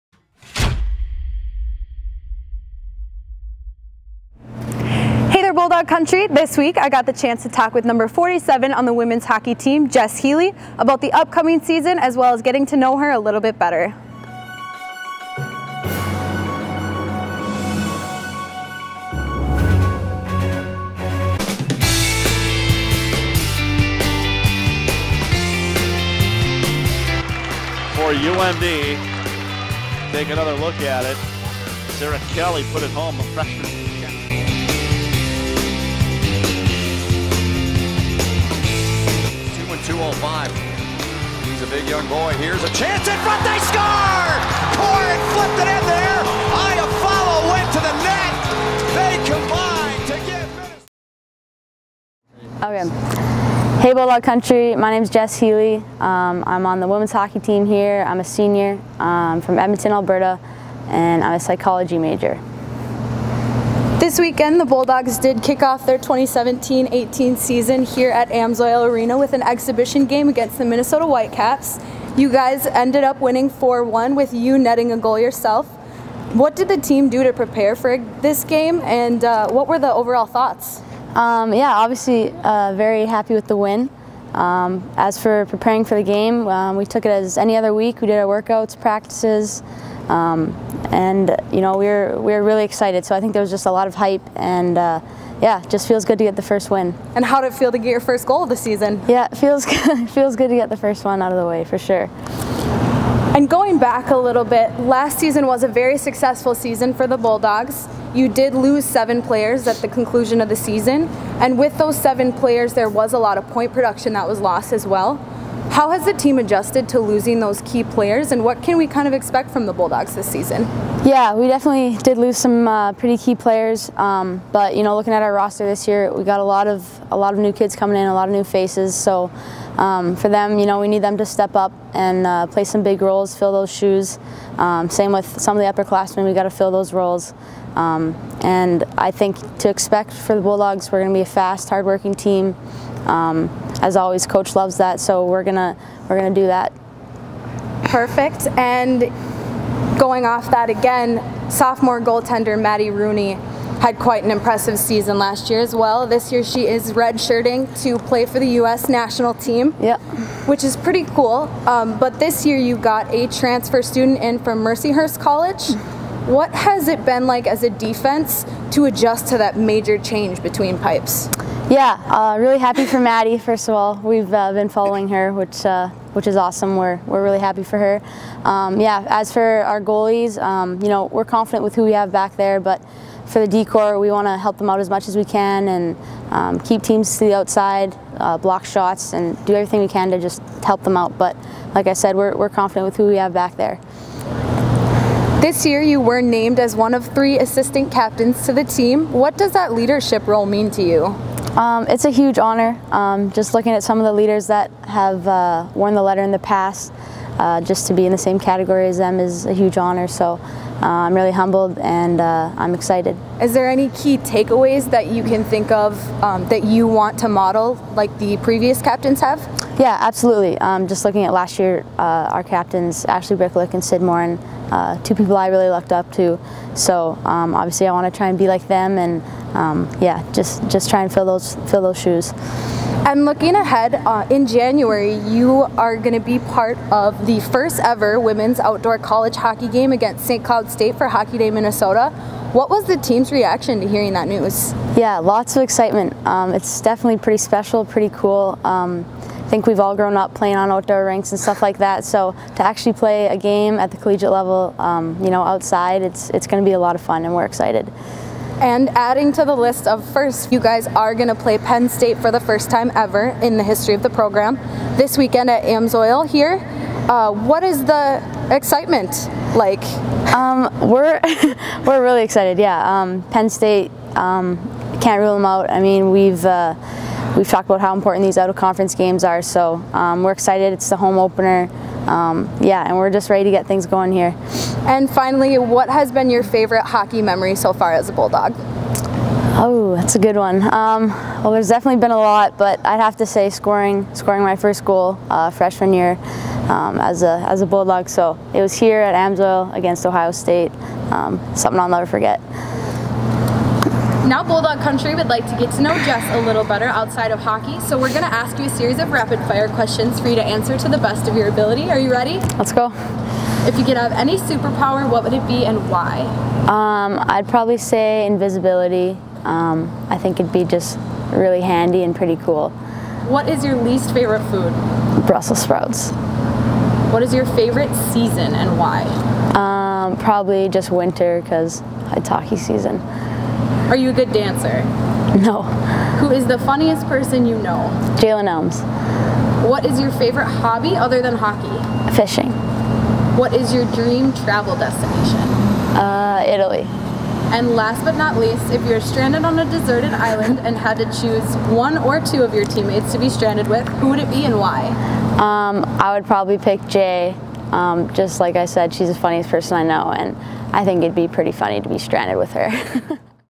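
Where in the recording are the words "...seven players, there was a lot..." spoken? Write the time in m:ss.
1:51.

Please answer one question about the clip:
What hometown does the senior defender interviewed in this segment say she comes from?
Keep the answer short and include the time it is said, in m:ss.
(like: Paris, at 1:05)
Edmonton, Alberta, at 0:59.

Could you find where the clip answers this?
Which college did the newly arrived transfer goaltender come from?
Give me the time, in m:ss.
2:44.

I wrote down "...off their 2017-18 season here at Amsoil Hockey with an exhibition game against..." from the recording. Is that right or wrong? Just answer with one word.
wrong.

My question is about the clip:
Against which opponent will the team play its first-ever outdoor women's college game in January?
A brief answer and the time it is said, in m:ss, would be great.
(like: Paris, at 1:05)
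St. Cloud State, at 4:00.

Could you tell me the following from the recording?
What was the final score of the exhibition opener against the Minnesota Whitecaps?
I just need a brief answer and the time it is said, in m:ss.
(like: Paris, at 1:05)
4-1, at 1:13.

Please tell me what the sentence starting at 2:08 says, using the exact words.
So um, for them, you know, we need them to step up and uh, play some big roles, fill those shoes.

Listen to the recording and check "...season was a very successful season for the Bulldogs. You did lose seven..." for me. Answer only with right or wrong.
right.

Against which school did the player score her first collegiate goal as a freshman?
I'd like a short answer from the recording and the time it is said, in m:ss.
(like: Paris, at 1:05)
Ohio State, at 5:00.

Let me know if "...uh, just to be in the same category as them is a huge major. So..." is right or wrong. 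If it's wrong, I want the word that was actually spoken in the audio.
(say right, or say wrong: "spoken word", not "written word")
wrong: "honor", not "major".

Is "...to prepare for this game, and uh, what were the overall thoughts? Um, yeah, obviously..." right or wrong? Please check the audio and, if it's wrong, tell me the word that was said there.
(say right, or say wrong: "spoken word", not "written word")
right.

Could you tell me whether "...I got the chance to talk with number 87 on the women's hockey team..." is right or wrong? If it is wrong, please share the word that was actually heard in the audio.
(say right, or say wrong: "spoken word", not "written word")
wrong: "47", not "87".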